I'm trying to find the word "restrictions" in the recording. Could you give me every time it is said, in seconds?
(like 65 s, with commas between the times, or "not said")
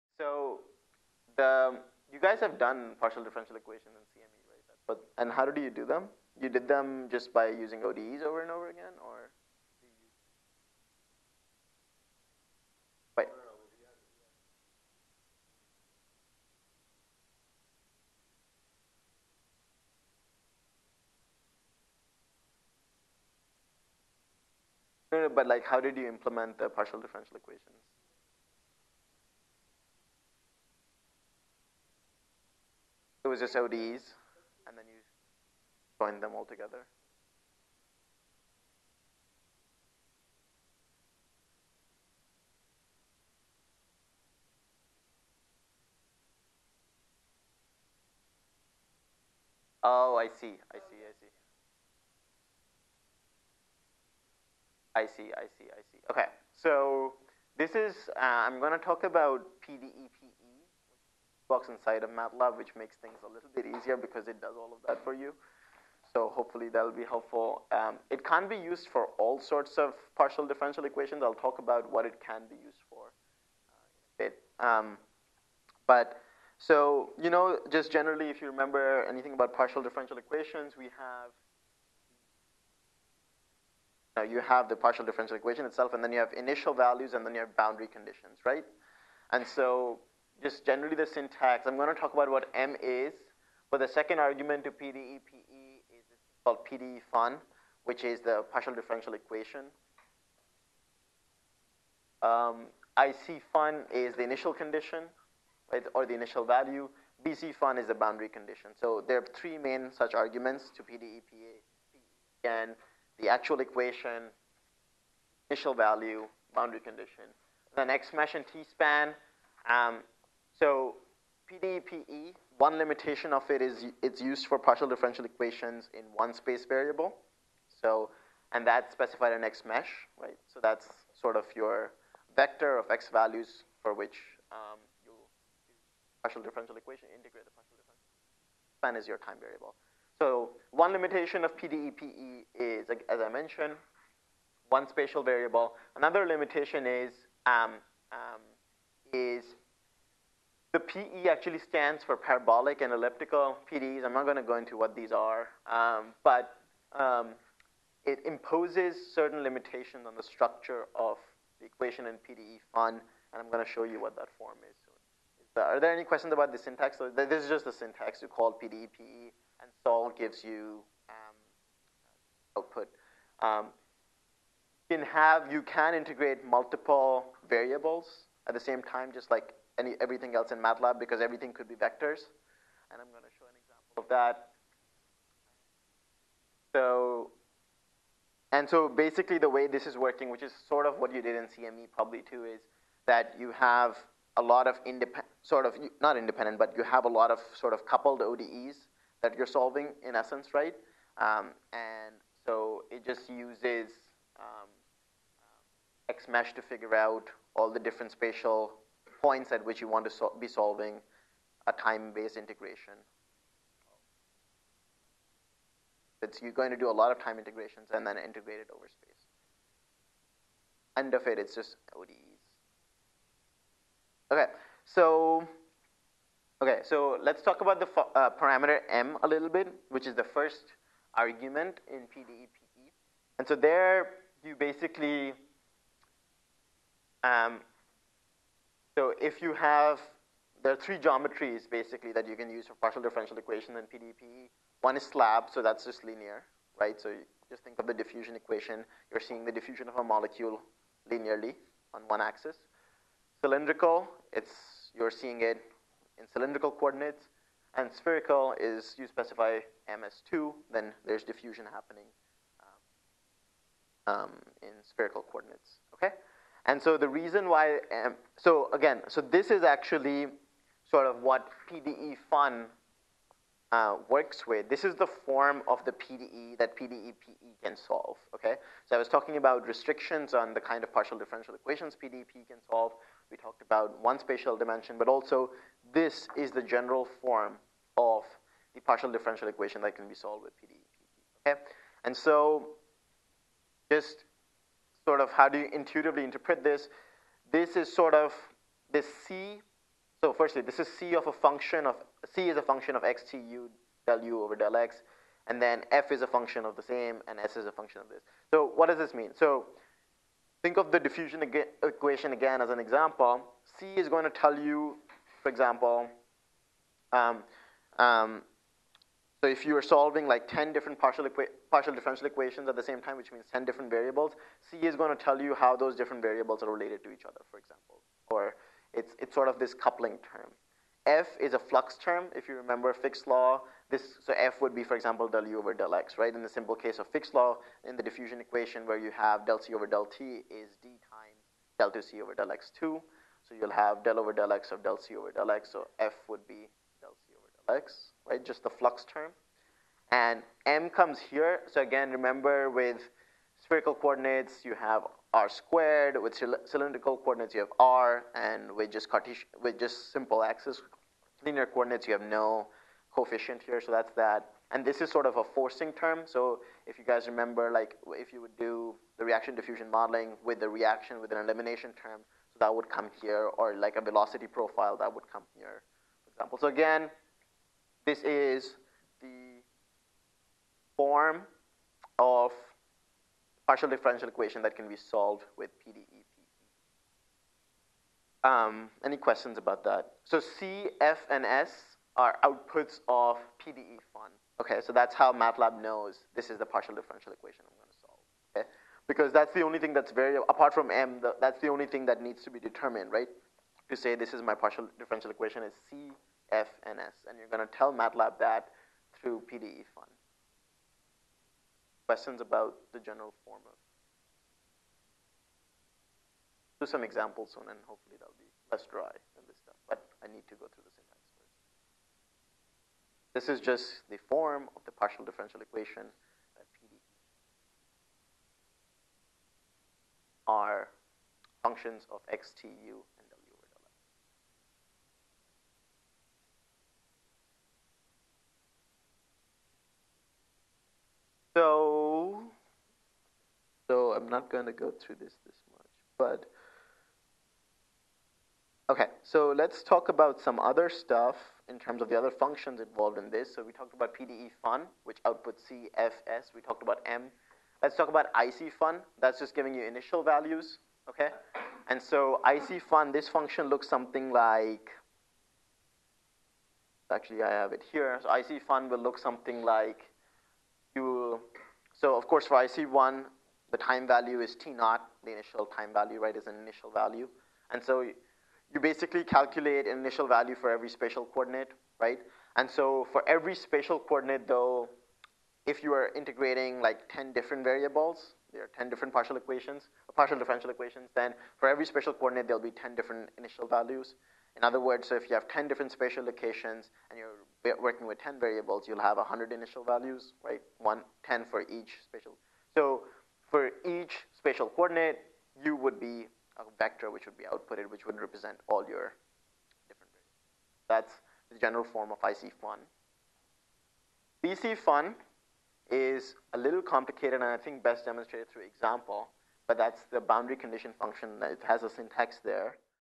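279 s.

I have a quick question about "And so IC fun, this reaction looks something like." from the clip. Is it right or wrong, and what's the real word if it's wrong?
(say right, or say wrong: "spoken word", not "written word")
wrong: "function", not "reaction".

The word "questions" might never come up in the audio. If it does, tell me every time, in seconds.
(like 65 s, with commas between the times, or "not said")
166 s, 389 s, 412 s.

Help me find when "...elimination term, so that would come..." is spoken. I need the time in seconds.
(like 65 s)
371 s.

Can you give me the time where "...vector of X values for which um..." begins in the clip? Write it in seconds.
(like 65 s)
132 s.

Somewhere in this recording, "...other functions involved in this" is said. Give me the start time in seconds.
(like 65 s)
452 s.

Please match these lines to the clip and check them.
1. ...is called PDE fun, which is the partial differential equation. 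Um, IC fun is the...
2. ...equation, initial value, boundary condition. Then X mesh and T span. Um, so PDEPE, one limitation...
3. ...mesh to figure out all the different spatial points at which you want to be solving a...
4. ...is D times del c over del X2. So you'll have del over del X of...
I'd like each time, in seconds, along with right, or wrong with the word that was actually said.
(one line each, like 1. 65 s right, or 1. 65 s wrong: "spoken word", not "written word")
1. 95 s right
2. 113 s right
3. 206 s right
4. 340 s right.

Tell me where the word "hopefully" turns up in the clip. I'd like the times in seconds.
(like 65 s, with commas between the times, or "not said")
66 s, 417 s.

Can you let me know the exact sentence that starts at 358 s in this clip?
And with just, Cartesian, with just simple axis linear coordinates, you have no coefficient here.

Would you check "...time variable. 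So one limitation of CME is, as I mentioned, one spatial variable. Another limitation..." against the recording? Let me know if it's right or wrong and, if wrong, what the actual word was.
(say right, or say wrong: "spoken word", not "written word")
wrong: "PDEPE", not "CME".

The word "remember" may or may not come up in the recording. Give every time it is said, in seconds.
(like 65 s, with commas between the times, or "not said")
78 s, 332 s, 352 s, 367 s.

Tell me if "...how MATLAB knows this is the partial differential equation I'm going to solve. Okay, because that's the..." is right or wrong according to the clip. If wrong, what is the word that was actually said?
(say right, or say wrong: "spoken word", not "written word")
right.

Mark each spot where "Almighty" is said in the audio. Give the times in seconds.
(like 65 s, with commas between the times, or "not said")
not said.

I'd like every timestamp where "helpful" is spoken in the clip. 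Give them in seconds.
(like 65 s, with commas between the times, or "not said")
67 s.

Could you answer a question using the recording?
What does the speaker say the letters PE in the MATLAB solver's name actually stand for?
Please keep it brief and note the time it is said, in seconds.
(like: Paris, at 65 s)
Parabolic and elliptical, at 152 s.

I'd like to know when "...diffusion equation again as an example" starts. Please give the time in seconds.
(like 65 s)
310 s.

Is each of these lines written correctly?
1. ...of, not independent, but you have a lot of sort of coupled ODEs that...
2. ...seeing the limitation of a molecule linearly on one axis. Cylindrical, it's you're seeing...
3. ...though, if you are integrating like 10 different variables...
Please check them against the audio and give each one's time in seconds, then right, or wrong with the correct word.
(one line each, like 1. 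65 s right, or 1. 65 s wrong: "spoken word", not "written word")
1. 195 s right
2. 249 s wrong: "diffusion", not "limitation"
3. 484 s right.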